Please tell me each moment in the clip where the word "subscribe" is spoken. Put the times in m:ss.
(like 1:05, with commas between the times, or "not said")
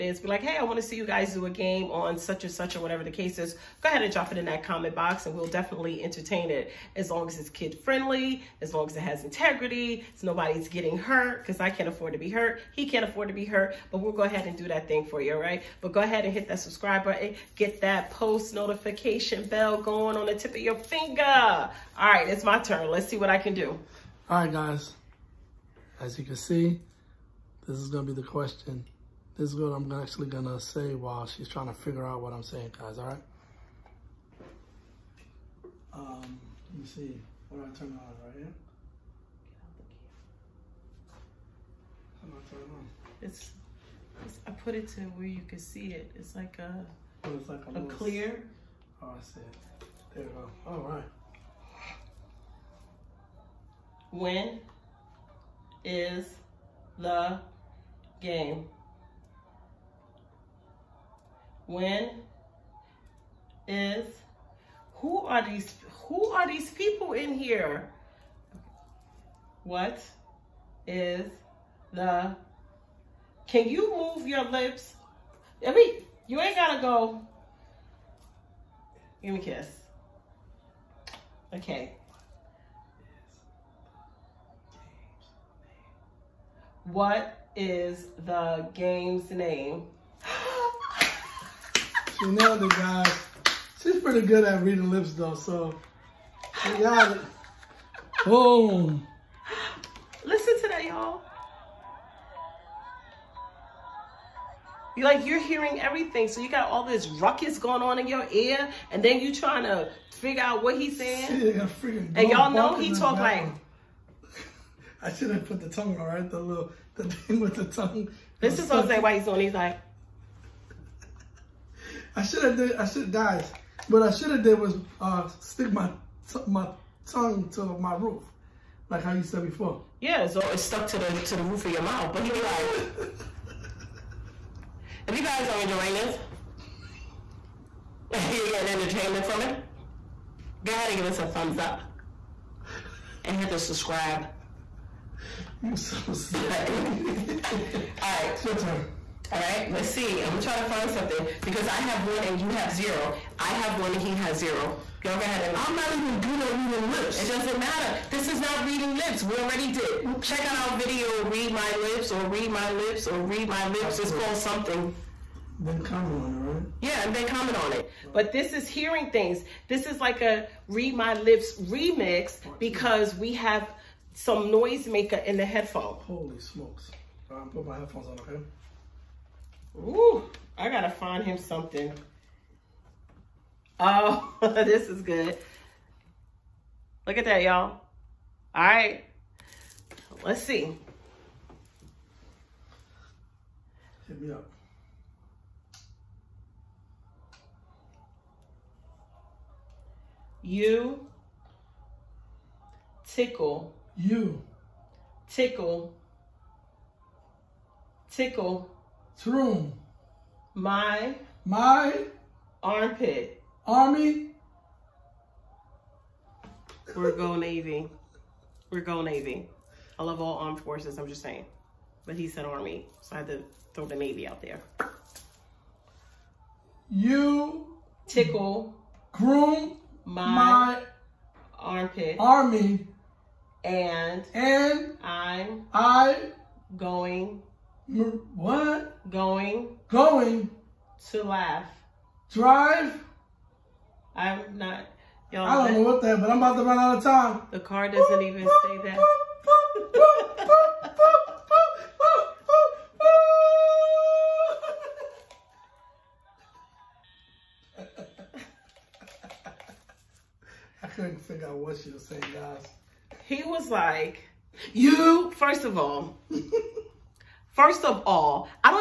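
0:16, 2:23.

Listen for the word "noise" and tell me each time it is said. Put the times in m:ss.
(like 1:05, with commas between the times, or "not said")
2:54.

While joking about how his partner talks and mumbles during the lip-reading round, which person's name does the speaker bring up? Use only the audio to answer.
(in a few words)
Jose.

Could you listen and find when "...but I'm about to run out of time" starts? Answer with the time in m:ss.
4:06.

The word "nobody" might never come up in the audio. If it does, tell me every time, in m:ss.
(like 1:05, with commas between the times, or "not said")
0:10.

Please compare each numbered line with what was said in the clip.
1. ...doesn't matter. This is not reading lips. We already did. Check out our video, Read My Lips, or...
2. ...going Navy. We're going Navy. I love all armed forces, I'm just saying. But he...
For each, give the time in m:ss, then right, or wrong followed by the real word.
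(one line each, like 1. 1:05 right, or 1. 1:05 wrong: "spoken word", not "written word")
1. 2:37 right
2. 3:37 right.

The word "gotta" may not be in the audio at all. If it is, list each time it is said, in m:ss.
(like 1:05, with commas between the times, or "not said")
1:16, 3:00.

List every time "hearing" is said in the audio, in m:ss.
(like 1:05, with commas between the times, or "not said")
1:45, 2:48.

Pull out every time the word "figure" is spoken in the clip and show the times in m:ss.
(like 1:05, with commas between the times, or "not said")
0:31, 1:50, 4:21.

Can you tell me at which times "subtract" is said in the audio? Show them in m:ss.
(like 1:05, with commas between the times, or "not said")
not said.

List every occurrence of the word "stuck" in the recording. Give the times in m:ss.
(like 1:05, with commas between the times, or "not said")
2:10.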